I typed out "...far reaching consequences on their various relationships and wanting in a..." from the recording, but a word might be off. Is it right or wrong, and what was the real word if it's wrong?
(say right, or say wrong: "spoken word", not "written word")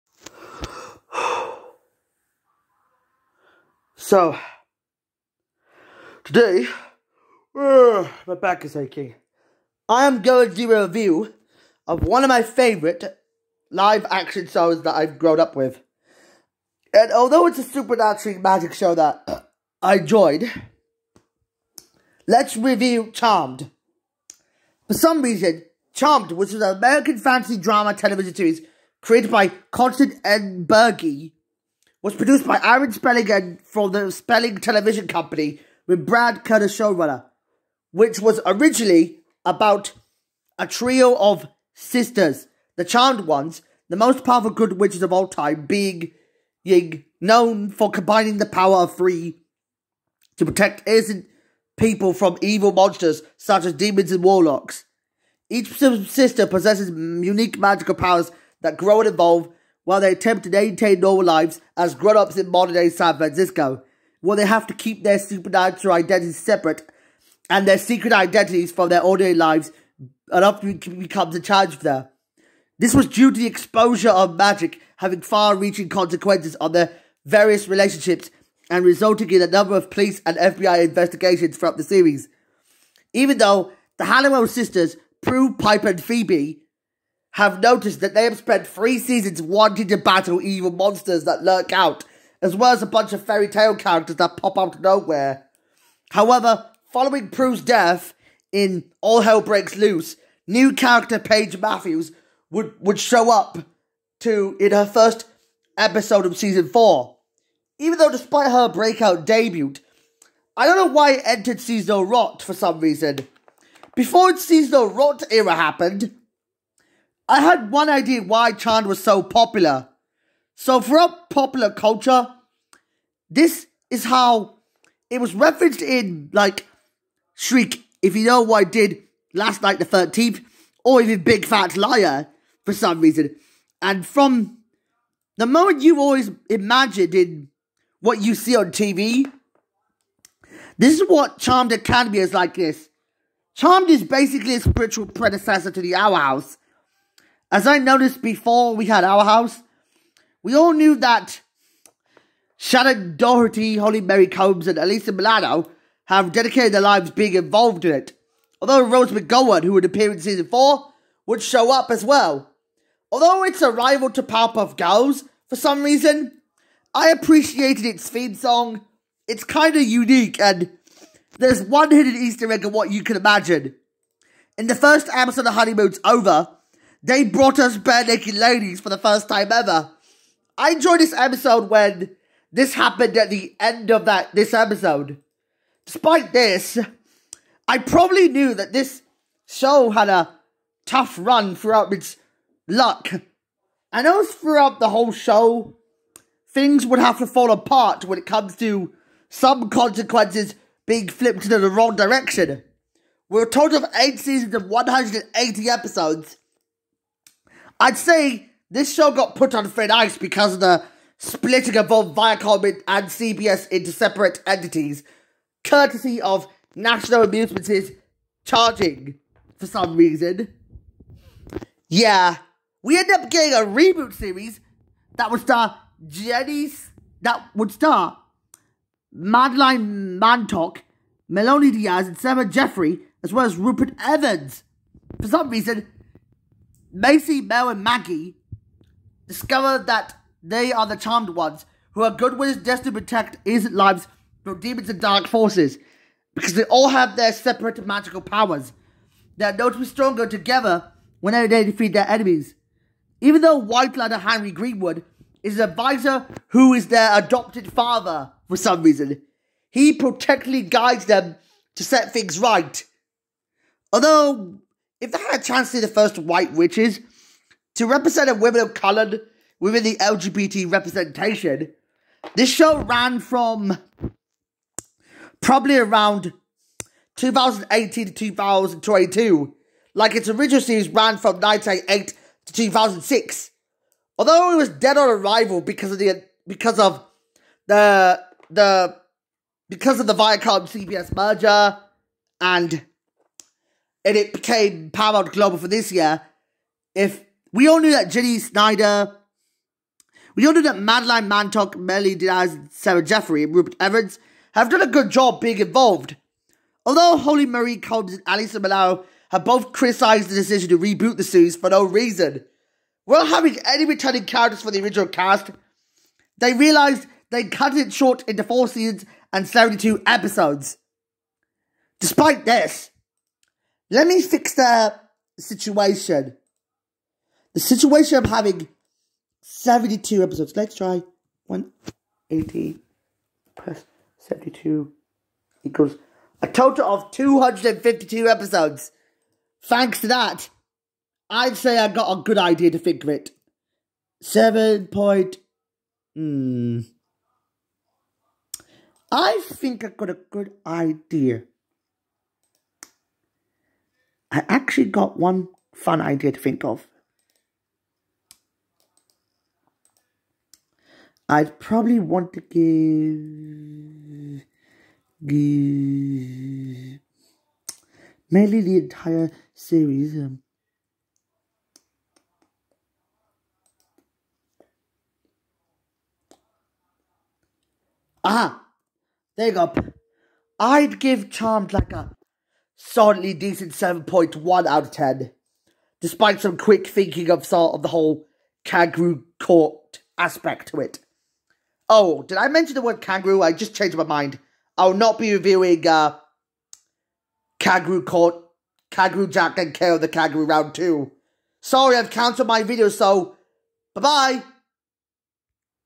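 wrong: "resulting", not "wanting".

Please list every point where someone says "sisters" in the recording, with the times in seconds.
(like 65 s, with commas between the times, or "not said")
41 s, 55 s, 84 s.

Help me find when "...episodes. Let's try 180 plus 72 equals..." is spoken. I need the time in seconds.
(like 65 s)
330 s.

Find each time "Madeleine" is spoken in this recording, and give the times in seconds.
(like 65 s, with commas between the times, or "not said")
229 s, 300 s.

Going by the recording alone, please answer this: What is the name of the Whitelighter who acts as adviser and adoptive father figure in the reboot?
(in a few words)
Henry Greenwood.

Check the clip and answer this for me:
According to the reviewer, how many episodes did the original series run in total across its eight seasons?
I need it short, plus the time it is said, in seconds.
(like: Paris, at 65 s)
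180, at 204 s.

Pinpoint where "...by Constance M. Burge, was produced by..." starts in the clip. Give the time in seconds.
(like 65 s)
29 s.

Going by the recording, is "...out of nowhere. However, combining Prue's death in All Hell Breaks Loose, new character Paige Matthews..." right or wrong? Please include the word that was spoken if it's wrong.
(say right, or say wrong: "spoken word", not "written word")
wrong: "following", not "combining".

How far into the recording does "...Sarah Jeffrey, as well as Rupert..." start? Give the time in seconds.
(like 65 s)
232 s.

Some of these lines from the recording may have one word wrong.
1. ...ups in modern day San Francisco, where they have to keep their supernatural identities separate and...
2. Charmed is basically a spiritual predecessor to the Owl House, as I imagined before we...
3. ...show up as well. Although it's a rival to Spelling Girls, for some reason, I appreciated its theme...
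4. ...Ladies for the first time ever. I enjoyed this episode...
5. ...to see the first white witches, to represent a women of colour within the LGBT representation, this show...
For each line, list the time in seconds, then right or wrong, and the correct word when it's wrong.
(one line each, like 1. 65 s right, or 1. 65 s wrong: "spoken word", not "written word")
1. 62 s right
2. 143 s wrong: "noticed", not "imagined"
3. 161 s wrong: "Powerpuff", not "Spelling"
4. 178 s right
5. 265 s right.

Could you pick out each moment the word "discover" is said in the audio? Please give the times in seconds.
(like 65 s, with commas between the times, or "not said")
239 s.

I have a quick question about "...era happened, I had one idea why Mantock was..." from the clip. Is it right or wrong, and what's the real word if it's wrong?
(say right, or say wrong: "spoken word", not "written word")
wrong: "Charmed", not "Mantock".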